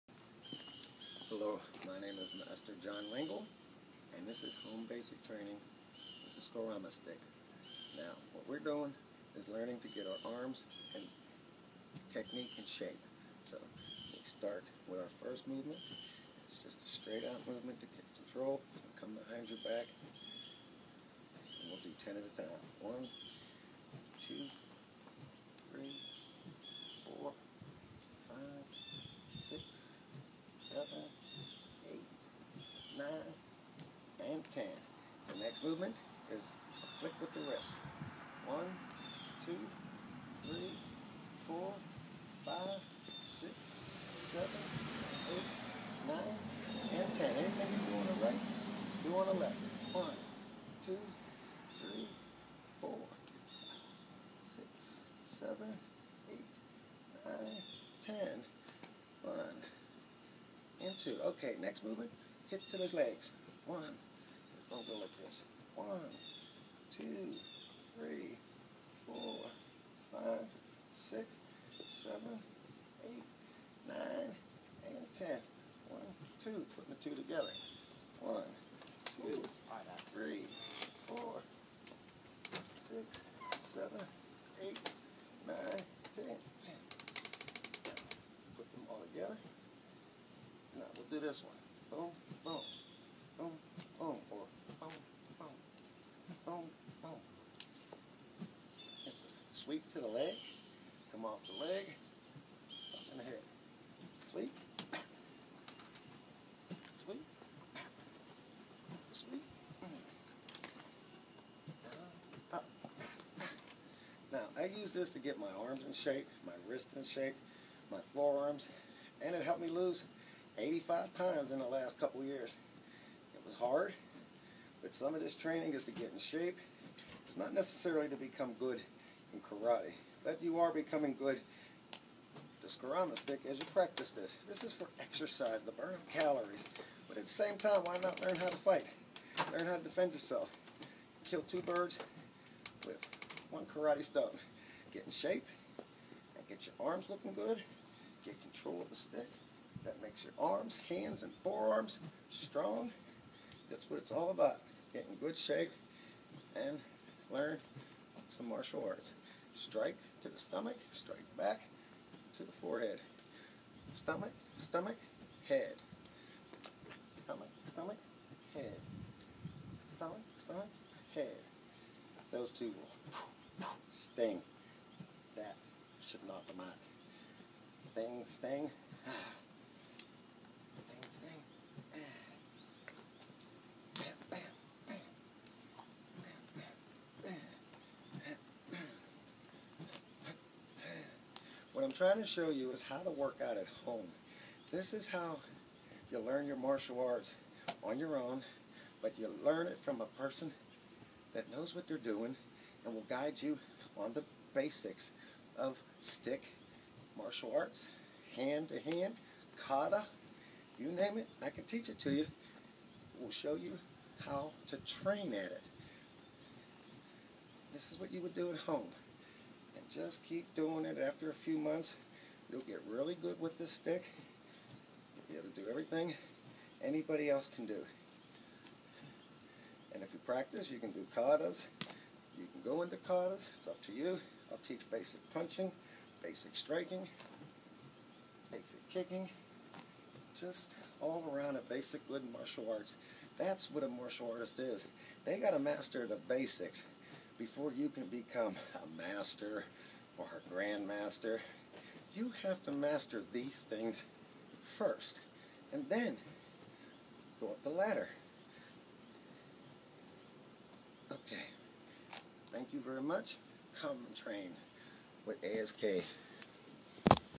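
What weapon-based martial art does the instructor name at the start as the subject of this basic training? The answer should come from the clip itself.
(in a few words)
Escrima.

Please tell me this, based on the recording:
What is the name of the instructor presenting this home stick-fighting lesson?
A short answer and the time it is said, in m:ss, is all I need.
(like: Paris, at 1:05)
John Lengyel, at 0:02.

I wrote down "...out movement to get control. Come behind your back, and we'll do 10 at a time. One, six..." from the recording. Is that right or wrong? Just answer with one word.
wrong.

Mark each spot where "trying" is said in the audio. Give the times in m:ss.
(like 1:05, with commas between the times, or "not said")
3:12.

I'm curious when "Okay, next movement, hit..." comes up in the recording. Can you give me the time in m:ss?
1:01.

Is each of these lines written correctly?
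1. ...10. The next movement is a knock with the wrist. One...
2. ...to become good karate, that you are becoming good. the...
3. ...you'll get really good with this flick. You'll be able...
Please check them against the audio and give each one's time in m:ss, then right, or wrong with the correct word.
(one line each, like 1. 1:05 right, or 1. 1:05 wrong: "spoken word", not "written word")
1. 0:34 wrong: "flick", not "knock"
2. 2:08 right
3. 3:42 wrong: "stick", not "flick".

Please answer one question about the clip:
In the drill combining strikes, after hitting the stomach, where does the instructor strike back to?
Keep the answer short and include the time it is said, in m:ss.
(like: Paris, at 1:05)
the forehead, at 2:42.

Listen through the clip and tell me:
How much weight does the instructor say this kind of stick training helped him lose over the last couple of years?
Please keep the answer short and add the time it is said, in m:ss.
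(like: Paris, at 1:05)
85 pounds, at 2:00.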